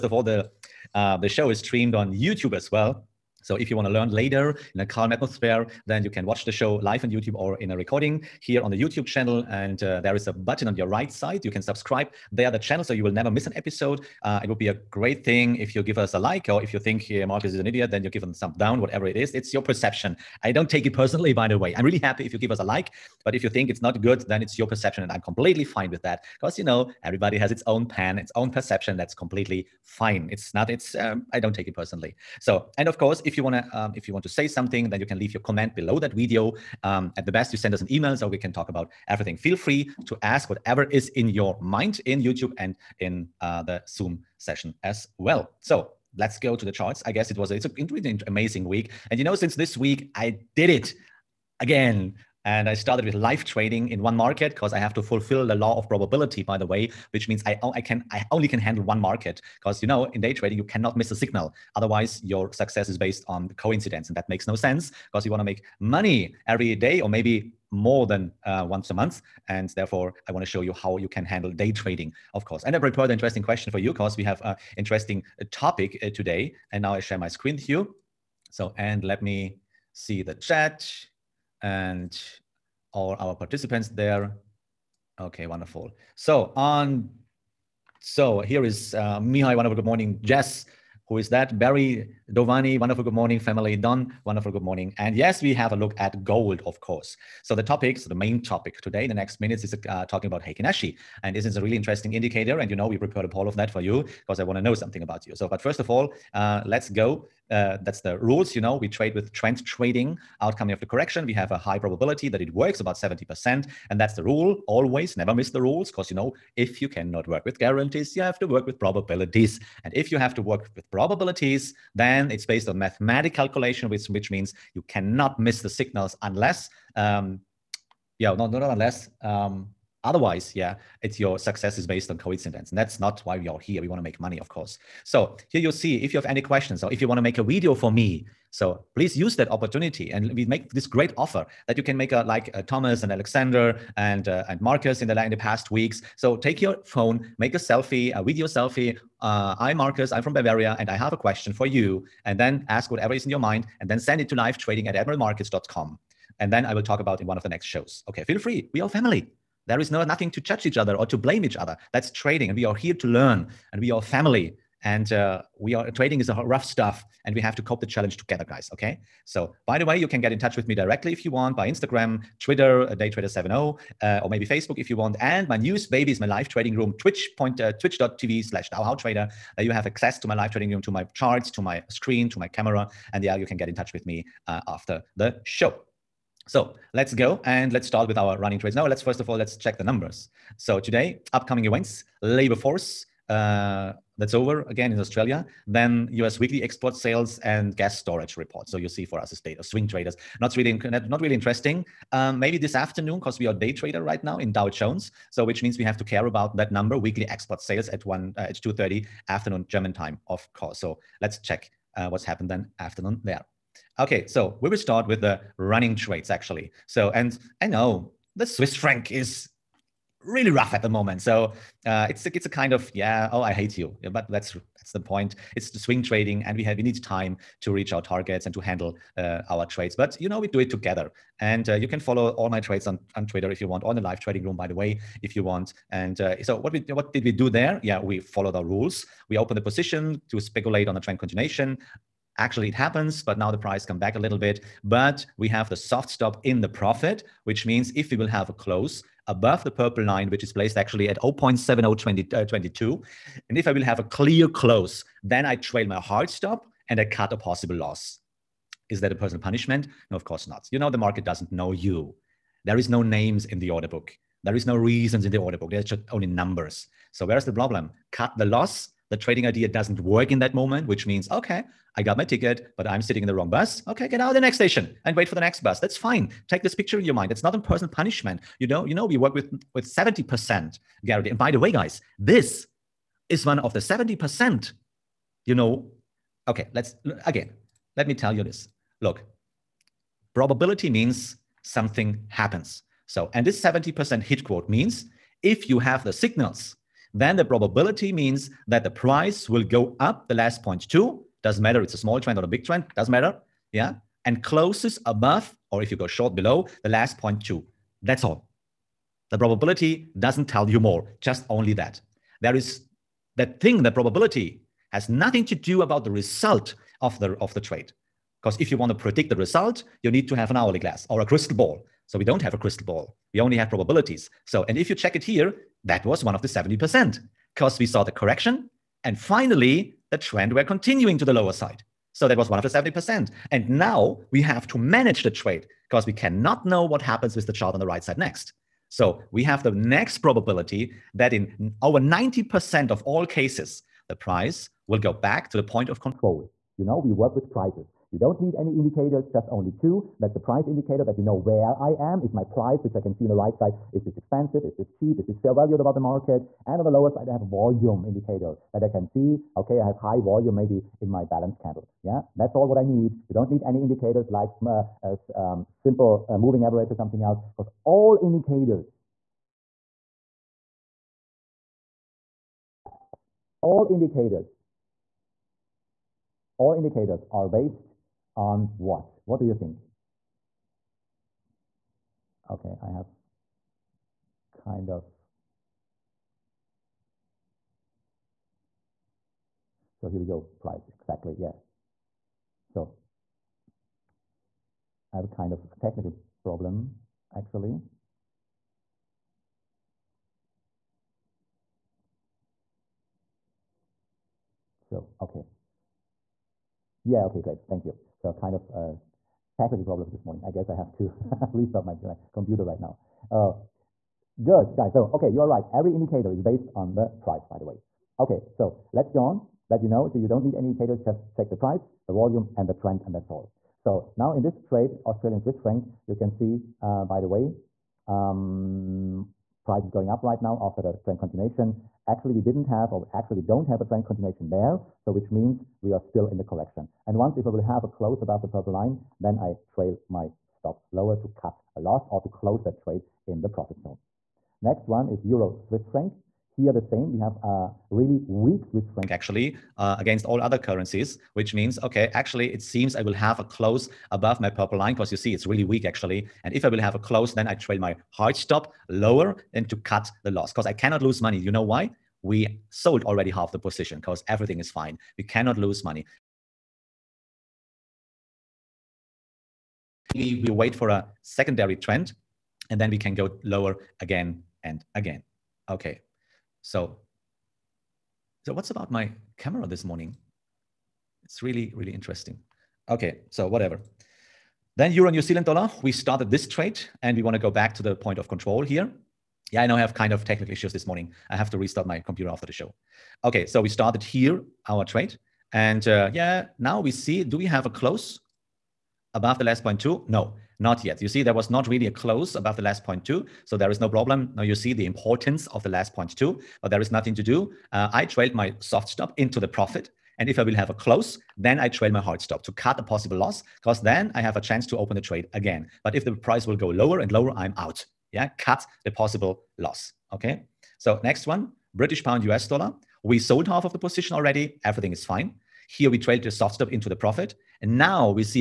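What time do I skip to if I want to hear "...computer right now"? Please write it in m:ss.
6:52.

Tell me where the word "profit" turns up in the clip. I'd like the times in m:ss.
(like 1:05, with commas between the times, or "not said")
4:06, 7:23, 8:29, 8:46.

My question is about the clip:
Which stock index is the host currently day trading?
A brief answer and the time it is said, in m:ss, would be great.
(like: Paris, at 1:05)
Dow Jones, at 3:24.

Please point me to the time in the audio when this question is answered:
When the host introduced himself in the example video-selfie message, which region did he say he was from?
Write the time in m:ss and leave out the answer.
2:30.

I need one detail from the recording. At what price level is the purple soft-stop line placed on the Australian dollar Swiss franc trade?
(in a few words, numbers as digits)
0.7022.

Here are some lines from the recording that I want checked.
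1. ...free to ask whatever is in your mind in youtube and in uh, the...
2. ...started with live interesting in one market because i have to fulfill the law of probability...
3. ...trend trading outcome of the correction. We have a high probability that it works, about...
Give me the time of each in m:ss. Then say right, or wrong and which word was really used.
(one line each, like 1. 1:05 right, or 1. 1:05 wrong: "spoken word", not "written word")
1. 0:39 right
2. 0:52 wrong: "trading", not "interesting"
3. 1:49 right.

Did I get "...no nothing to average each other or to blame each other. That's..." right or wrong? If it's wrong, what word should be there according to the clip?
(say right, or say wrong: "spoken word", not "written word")
wrong: "judge", not "average".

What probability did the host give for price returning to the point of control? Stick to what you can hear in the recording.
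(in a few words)
over 90%.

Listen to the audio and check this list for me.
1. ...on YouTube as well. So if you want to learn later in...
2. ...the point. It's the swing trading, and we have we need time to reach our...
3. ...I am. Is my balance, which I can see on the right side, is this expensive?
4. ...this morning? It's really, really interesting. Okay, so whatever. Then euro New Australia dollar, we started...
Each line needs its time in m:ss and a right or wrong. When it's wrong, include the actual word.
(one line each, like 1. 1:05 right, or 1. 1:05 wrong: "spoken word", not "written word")
1. 0:01 right
2. 3:44 right
3. 5:51 wrong: "price", not "balance"
4. 7:59 wrong: "Zealand", not "Australia".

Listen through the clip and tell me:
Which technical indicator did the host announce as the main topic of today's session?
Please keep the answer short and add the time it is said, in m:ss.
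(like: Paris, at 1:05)
Heikin Ashi, at 1:40.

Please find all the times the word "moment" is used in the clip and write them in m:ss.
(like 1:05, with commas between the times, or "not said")
3:40, 4:30.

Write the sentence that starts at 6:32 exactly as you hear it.
So I have a kind of technical problem, actually.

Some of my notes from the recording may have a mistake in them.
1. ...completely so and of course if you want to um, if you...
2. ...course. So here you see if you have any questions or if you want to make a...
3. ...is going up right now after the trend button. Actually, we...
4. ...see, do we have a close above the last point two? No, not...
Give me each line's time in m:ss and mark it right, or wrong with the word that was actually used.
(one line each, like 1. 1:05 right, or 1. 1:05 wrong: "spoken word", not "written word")
1. 0:31 wrong: "personally", not "completely"
2. 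2:14 right
3. 7:09 wrong: "continuation", not "button"
4. 8:16 right.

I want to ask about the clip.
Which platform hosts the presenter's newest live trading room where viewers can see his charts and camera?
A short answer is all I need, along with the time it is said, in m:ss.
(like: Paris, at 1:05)
Twitch, at 2:57.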